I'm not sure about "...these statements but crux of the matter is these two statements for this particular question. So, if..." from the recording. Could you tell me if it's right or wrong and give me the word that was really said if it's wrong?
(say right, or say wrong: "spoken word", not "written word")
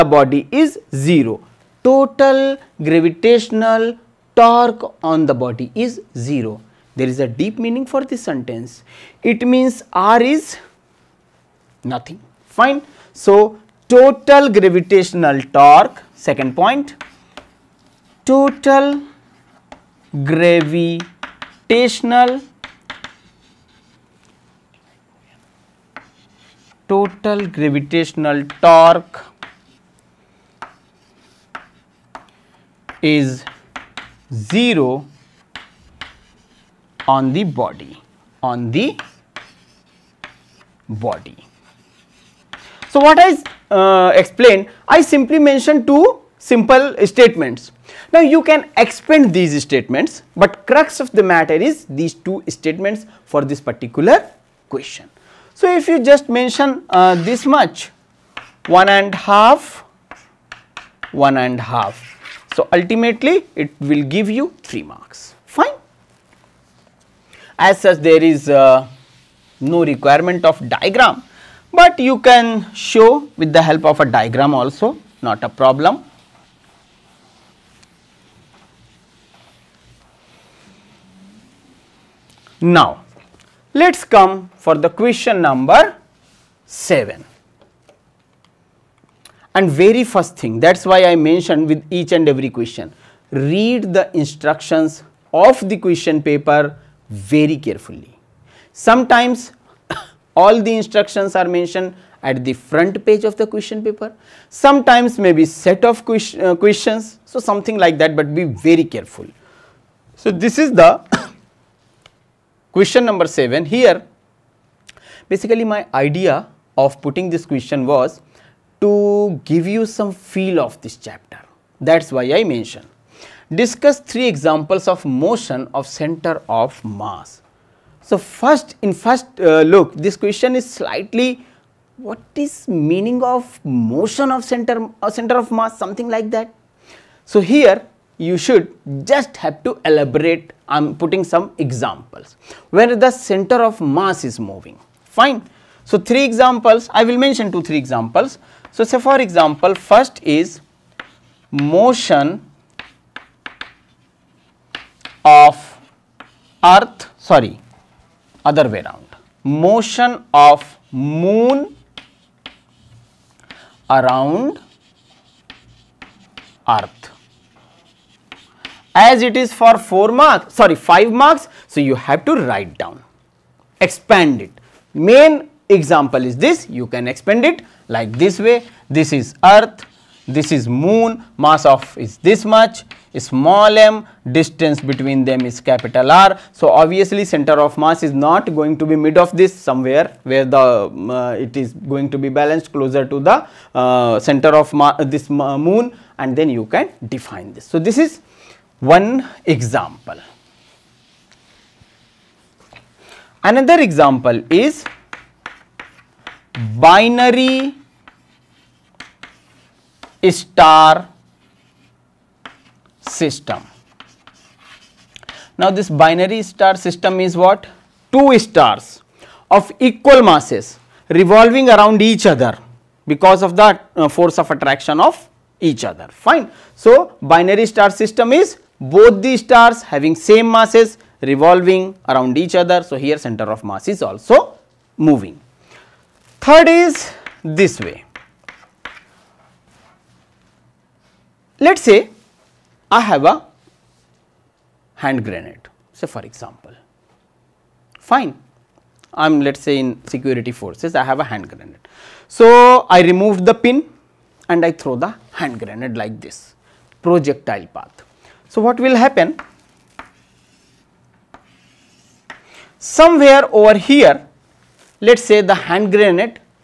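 right.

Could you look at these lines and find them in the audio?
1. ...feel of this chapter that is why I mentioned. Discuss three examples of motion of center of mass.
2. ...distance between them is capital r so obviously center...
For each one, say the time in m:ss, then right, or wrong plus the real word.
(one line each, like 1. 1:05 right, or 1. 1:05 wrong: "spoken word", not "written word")
1. 2:00 right
2. 3:04 right.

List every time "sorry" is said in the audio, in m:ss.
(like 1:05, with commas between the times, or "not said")
2:37, 2:50.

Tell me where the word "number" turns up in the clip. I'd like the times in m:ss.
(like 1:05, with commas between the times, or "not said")
1:25, 1:53.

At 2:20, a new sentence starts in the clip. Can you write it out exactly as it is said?
I am putting some examples where the center of mass is moving.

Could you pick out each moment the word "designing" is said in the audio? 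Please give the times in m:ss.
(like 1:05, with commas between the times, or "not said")
not said.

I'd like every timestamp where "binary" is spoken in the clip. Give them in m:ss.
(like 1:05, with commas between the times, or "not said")
3:26, 3:35, 3:47.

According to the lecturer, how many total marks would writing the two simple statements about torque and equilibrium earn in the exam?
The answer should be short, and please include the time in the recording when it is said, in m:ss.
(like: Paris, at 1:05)
3, at 1:04.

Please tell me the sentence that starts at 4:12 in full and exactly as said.
So, I remove the pin and I throw the hand grenade like this projectile path.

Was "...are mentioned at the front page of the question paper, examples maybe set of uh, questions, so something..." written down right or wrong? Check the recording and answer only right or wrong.
wrong.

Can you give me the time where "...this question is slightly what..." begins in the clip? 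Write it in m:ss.
2:09.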